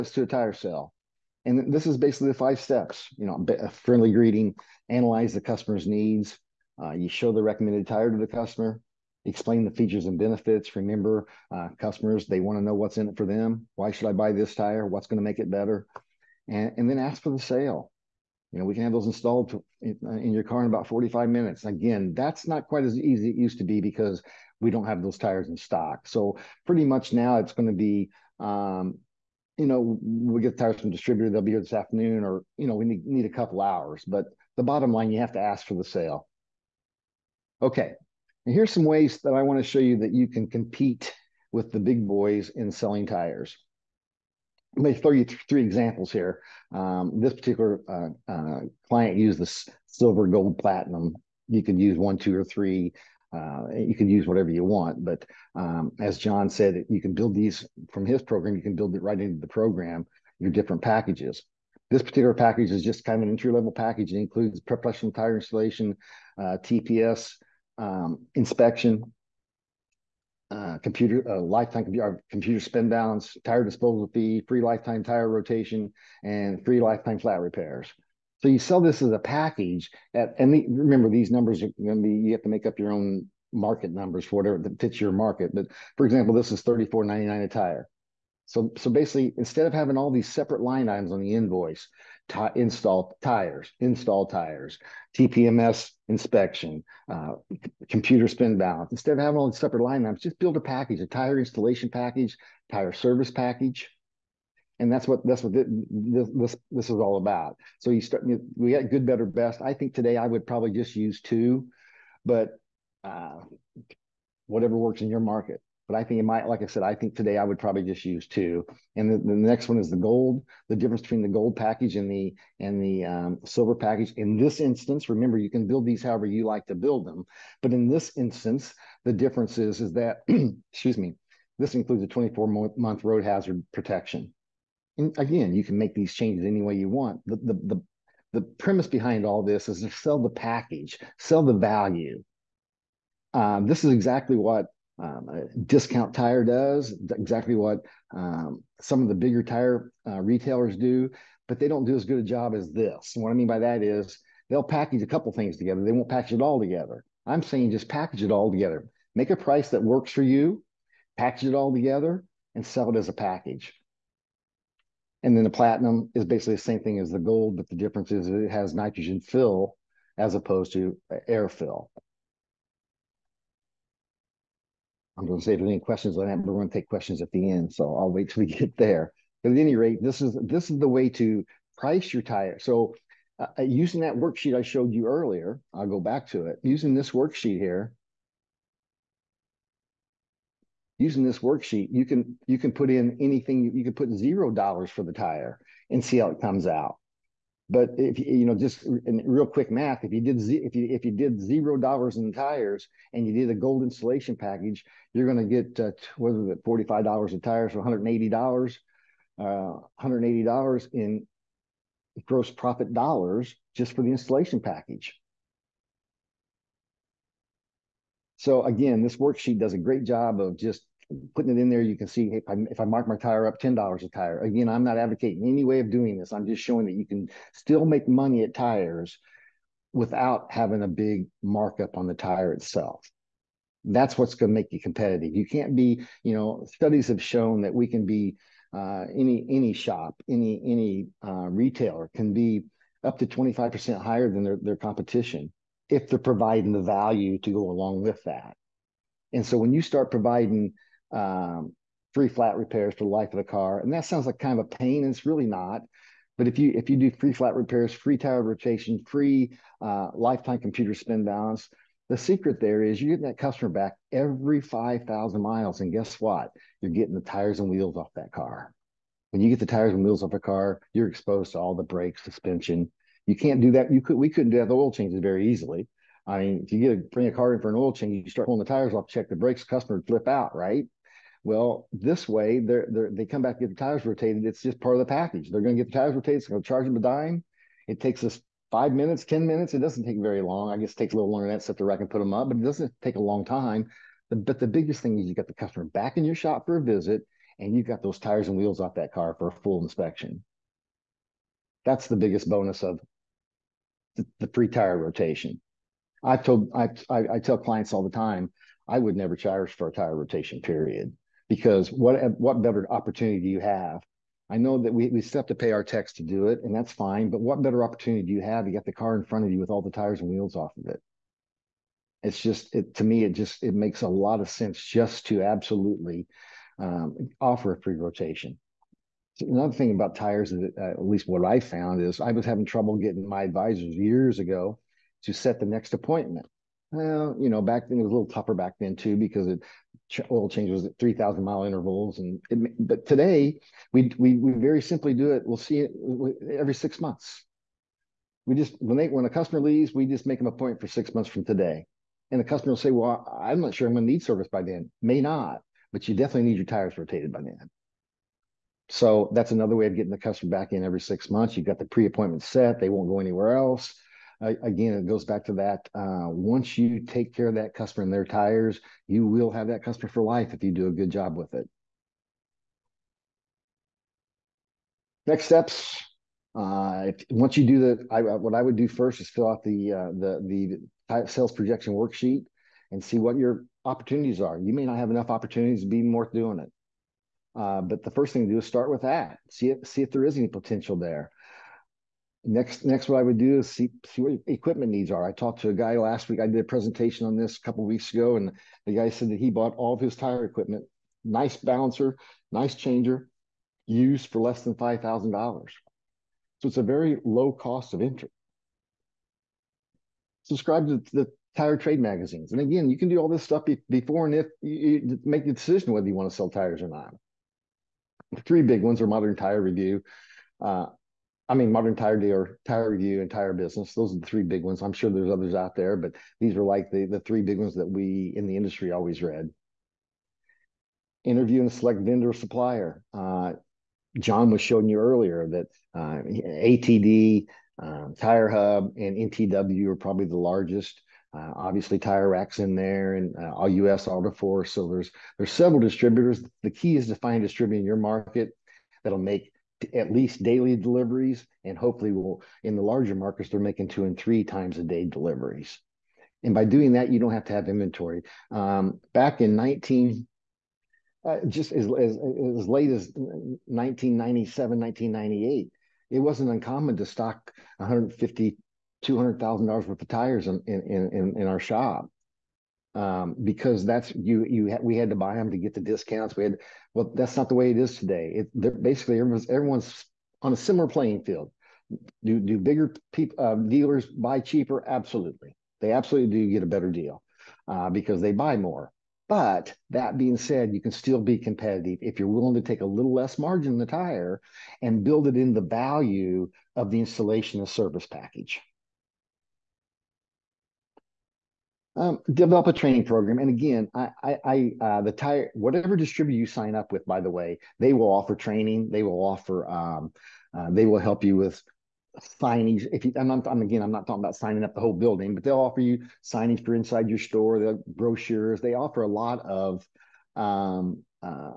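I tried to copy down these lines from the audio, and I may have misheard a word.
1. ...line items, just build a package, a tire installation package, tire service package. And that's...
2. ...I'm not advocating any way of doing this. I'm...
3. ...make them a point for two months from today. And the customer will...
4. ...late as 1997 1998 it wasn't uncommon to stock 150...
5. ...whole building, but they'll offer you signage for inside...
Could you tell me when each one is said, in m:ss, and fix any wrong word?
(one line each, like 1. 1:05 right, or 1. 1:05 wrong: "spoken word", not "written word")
1. 1:39 right
2. 3:44 right
3. 5:50 wrong: "six", not "two"
4. 7:42 right
5. 8:34 right.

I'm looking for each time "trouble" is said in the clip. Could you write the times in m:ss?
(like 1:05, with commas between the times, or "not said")
5:32.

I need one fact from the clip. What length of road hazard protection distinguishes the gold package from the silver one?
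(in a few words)
24 months.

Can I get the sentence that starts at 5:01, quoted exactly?
That's the biggest bonus of the, the free tire rotation.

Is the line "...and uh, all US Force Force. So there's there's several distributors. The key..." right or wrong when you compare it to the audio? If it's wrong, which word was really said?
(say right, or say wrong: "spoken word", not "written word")
wrong: "Auto", not "Force".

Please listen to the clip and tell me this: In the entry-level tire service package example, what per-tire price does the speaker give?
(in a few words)
$34.99.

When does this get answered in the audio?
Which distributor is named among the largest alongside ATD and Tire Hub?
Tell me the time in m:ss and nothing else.
7:19.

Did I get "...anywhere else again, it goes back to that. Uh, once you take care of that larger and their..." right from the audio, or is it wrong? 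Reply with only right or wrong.
wrong.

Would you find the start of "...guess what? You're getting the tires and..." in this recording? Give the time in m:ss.
4:25.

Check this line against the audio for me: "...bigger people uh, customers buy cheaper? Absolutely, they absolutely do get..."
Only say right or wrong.
wrong.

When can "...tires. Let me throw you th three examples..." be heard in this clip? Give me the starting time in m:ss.
0:43.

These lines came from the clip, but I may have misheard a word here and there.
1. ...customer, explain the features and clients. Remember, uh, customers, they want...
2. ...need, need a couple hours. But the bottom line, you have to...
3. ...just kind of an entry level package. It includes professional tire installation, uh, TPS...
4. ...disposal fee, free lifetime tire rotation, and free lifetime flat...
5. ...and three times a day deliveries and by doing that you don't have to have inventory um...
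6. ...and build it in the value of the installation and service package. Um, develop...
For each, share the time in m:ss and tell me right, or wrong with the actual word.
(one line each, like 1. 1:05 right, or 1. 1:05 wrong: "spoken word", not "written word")
1. 0:08 wrong: "benefits", not "clients"
2. 0:32 right
3. 1:02 right
4. 1:13 right
5. 7:34 right
6. 8:14 right.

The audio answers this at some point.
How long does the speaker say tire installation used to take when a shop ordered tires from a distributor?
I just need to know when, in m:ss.
0:20.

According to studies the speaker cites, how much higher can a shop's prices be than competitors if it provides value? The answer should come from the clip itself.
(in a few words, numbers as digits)
25%.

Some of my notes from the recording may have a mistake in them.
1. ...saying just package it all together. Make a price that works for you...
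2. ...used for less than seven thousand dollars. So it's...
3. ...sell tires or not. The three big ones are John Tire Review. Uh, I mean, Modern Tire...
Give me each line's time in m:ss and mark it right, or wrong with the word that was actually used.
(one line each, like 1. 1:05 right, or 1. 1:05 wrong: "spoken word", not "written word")
1. 2:37 right
2. 6:43 wrong: "five", not "seven"
3. 6:56 wrong: "Modern", not "John".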